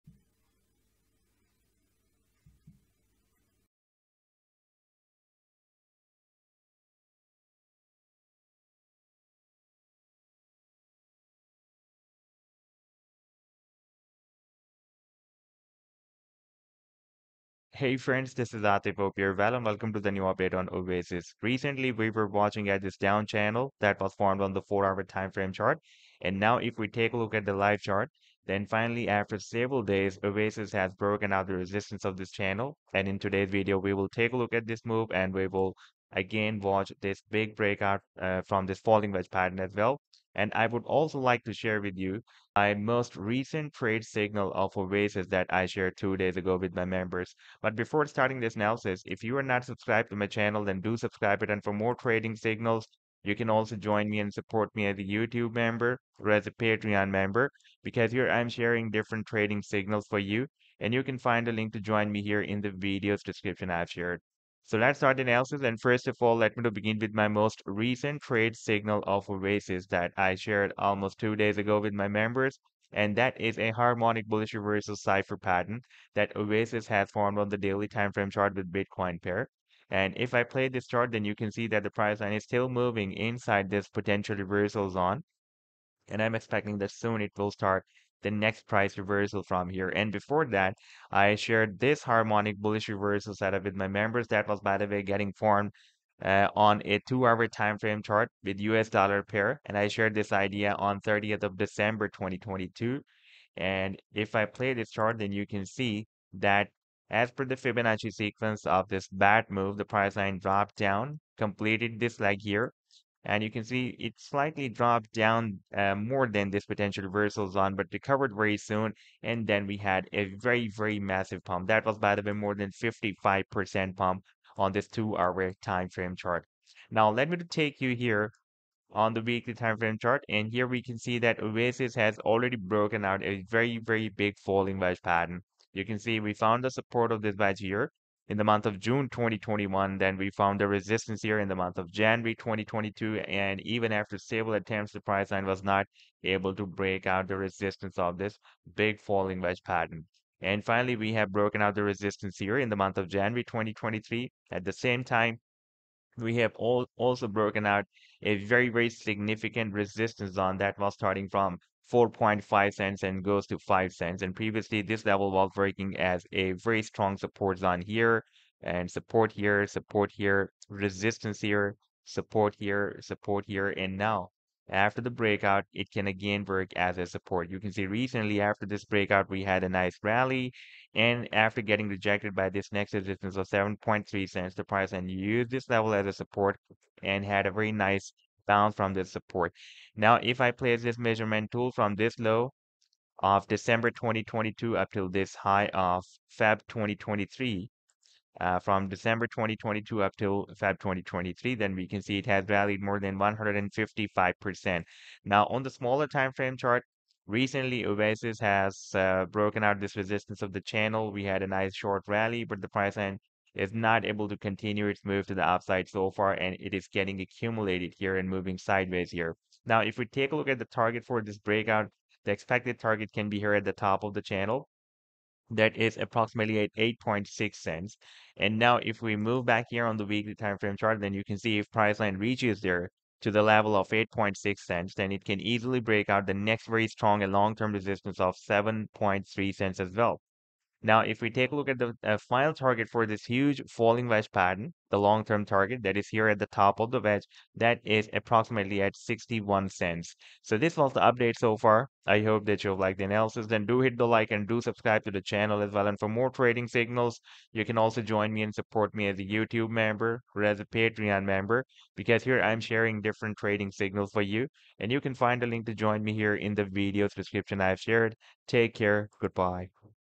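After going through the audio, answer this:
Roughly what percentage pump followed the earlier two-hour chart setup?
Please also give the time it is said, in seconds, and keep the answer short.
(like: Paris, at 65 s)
more than 55%, at 122 s.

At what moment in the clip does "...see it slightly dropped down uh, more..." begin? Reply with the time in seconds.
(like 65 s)
113 s.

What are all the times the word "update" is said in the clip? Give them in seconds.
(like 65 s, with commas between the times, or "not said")
20 s, 251 s.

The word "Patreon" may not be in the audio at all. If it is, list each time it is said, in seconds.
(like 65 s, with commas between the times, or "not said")
56 s, 260 s.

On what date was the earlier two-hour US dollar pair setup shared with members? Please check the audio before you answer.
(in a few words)
30 December 2022.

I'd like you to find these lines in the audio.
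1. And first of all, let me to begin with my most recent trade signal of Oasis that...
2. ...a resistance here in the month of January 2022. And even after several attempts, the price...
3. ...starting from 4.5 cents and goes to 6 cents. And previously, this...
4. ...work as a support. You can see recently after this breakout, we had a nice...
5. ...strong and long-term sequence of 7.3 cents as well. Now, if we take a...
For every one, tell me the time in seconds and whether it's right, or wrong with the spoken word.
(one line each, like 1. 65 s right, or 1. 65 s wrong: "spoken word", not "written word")
1. 65 s right
2. 140 s right
3. 160 s wrong: "5", not "6"
4. 176 s right
5. 236 s wrong: "resistance", not "sequence".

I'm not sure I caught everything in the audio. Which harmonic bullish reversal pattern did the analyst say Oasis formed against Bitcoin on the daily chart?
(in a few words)
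cipher.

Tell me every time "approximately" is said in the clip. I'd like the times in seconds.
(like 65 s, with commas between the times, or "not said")
225 s, 248 s.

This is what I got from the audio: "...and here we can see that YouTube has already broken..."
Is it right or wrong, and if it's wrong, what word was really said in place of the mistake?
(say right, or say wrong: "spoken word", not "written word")
wrong: "Oasis", not "YouTube".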